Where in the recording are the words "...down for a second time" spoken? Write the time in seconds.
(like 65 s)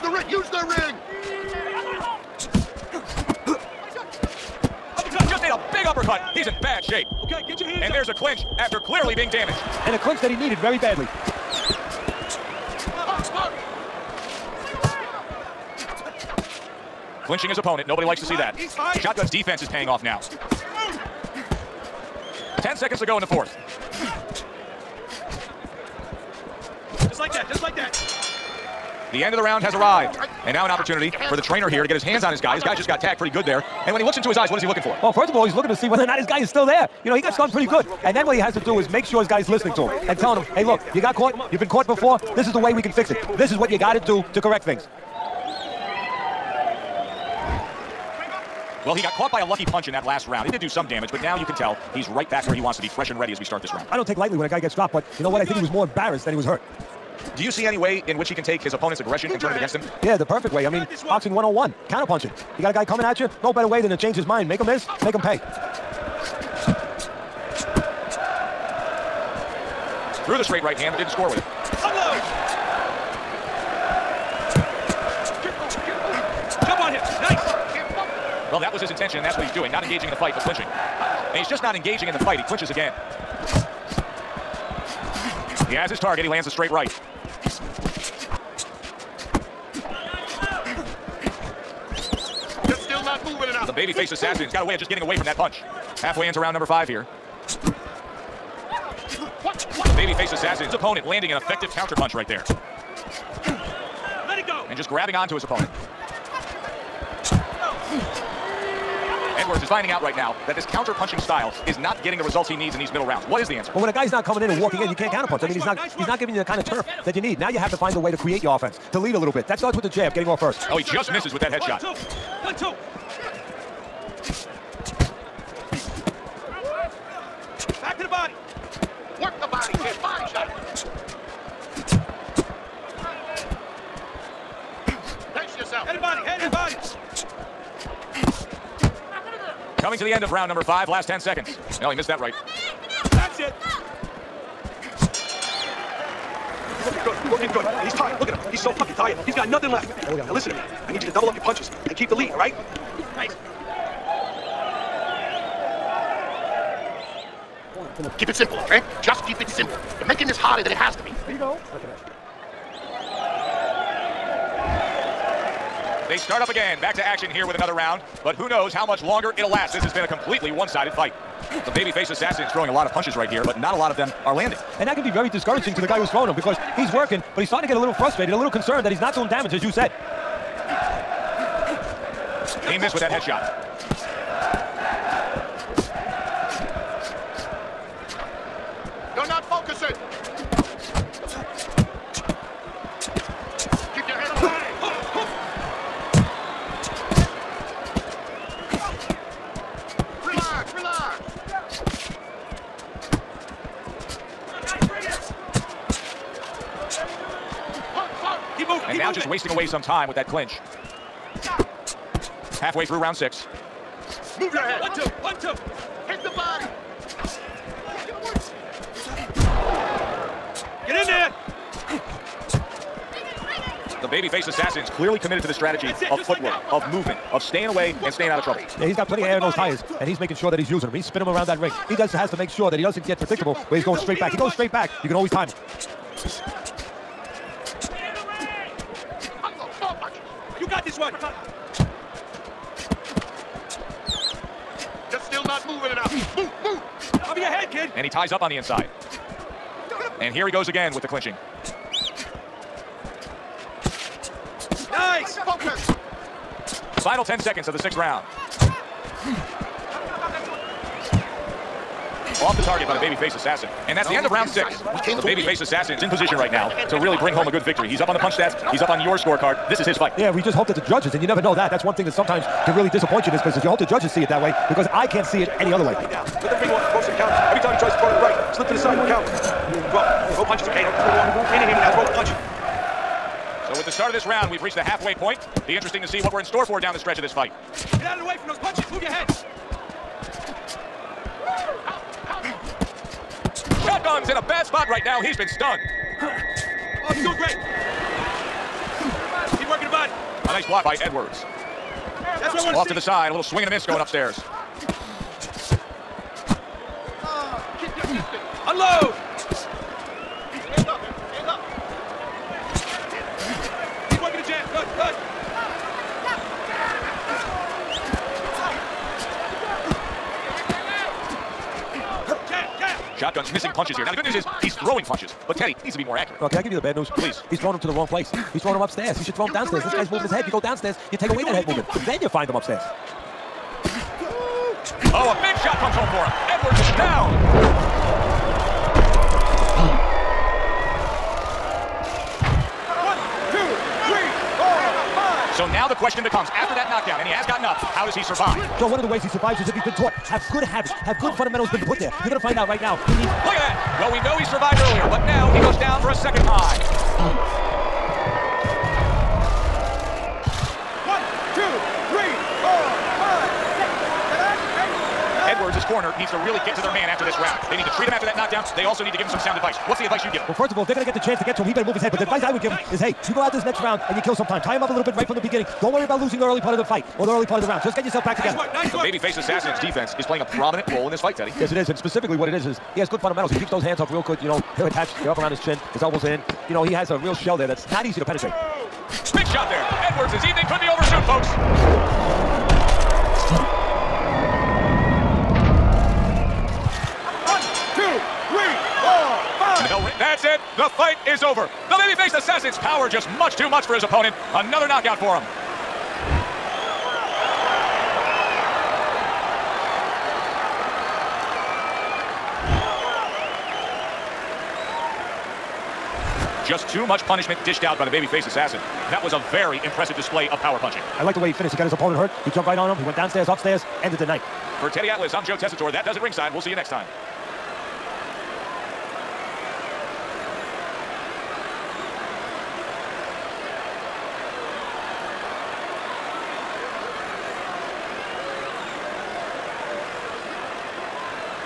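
355 s.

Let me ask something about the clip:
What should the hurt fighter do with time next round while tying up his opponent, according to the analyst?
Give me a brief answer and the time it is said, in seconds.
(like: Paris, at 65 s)
Kill some time, at 374 s.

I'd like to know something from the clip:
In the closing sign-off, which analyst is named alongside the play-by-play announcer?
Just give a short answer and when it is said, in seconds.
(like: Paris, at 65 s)
Teddy Atlas, at 424 s.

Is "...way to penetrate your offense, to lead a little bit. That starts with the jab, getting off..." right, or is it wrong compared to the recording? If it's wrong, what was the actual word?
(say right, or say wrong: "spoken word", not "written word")
wrong: "create", not "penetrate".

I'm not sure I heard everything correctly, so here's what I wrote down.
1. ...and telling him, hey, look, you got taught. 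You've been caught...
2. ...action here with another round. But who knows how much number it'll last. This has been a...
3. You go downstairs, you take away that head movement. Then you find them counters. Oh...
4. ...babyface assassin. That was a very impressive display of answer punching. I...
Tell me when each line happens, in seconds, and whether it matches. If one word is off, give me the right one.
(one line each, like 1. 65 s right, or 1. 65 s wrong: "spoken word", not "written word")
1. 40 s wrong: "caught", not "taught"
2. 167 s wrong: "longer", not "number"
3. 330 s wrong: "upstairs", not "counters"
4. 418 s wrong: "power", not "answer".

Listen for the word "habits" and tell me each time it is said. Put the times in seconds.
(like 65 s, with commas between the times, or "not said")
350 s.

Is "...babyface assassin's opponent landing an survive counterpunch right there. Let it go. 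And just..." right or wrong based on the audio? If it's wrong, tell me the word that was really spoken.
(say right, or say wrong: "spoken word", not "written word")
wrong: "effective", not "survive".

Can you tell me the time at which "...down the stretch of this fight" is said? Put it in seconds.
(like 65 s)
286 s.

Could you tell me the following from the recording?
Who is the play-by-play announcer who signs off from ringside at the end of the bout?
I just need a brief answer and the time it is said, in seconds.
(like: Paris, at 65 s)
Joe Tessitore, at 425 s.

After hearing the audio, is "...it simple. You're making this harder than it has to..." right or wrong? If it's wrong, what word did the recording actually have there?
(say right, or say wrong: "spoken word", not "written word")
right.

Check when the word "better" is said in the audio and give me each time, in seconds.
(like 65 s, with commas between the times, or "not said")
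63 s, 371 s.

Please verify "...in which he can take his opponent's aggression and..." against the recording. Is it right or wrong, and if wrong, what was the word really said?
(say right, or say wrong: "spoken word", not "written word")
right.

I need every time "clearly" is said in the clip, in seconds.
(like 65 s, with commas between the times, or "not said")
8 s, 224 s.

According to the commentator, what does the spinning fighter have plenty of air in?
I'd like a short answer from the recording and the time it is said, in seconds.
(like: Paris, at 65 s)
Tires, at 229 s.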